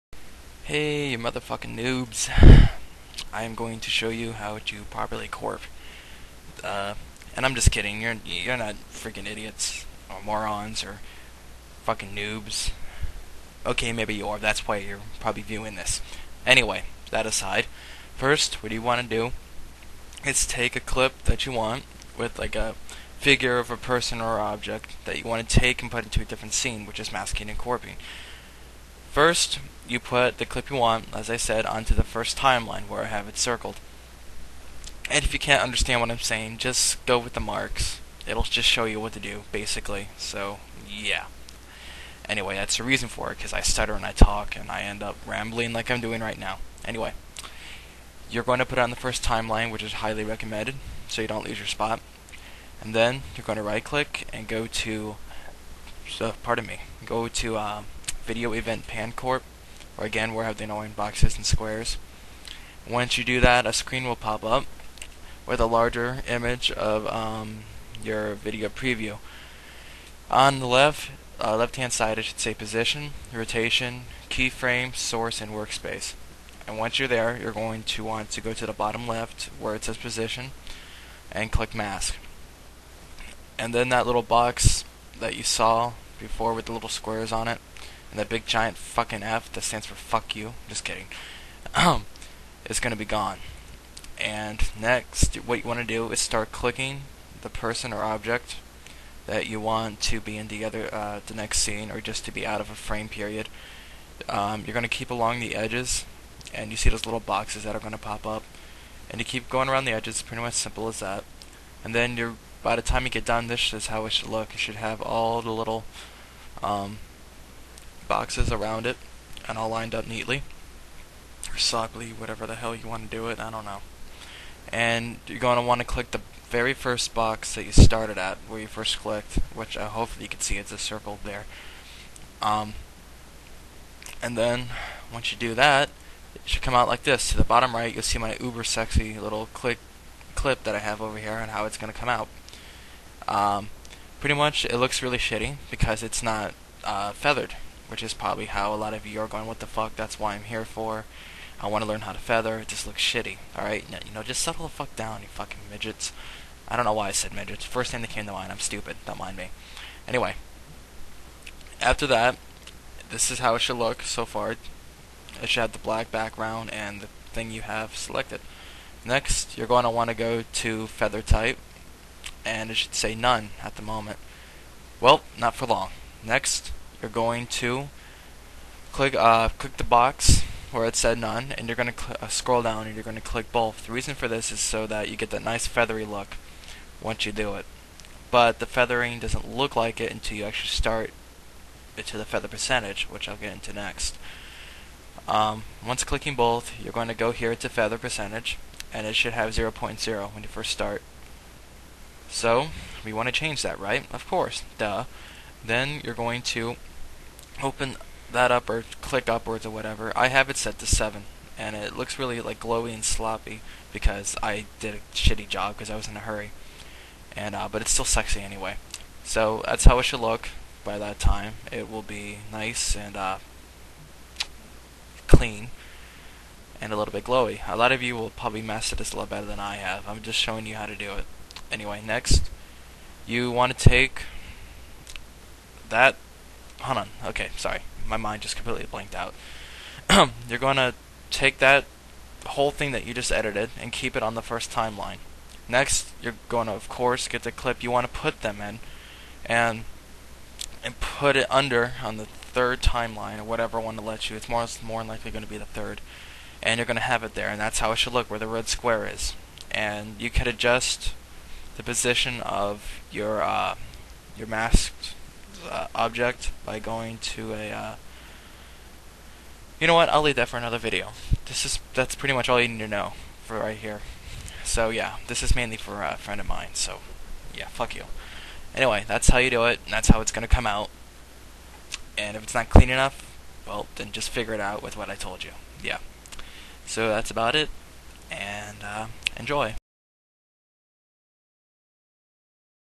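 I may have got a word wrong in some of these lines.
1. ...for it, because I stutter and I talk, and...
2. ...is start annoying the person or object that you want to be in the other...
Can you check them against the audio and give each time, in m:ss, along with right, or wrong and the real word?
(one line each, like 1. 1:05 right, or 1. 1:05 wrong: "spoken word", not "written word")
1. 0:43 right
2. 1:36 wrong: "clicking", not "annoying".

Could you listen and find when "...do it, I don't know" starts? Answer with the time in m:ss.
2:03.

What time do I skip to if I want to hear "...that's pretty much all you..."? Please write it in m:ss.
4:31.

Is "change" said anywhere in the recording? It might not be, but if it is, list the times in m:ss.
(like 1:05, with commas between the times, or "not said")
3:23.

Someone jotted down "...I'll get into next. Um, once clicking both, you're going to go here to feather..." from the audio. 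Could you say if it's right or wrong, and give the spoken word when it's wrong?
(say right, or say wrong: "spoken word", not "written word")
right.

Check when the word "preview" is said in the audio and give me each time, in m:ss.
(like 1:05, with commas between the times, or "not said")
1:08.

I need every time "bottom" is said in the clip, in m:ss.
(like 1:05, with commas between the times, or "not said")
1:18, 2:17.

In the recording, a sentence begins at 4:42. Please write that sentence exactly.
And if it's not clean enough, well, then just figure it out with what I told you.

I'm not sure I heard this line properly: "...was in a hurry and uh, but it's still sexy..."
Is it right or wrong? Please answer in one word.
right.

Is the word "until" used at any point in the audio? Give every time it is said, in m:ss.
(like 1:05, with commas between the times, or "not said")
3:10.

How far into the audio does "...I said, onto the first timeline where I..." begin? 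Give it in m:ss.
0:31.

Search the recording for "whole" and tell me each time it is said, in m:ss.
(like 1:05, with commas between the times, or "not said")
4:02.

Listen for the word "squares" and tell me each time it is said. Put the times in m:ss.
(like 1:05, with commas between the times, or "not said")
1:01, 1:26, 4:18.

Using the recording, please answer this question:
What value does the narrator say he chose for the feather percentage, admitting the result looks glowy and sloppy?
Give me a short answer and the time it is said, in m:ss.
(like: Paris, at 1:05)
7, at 3:30.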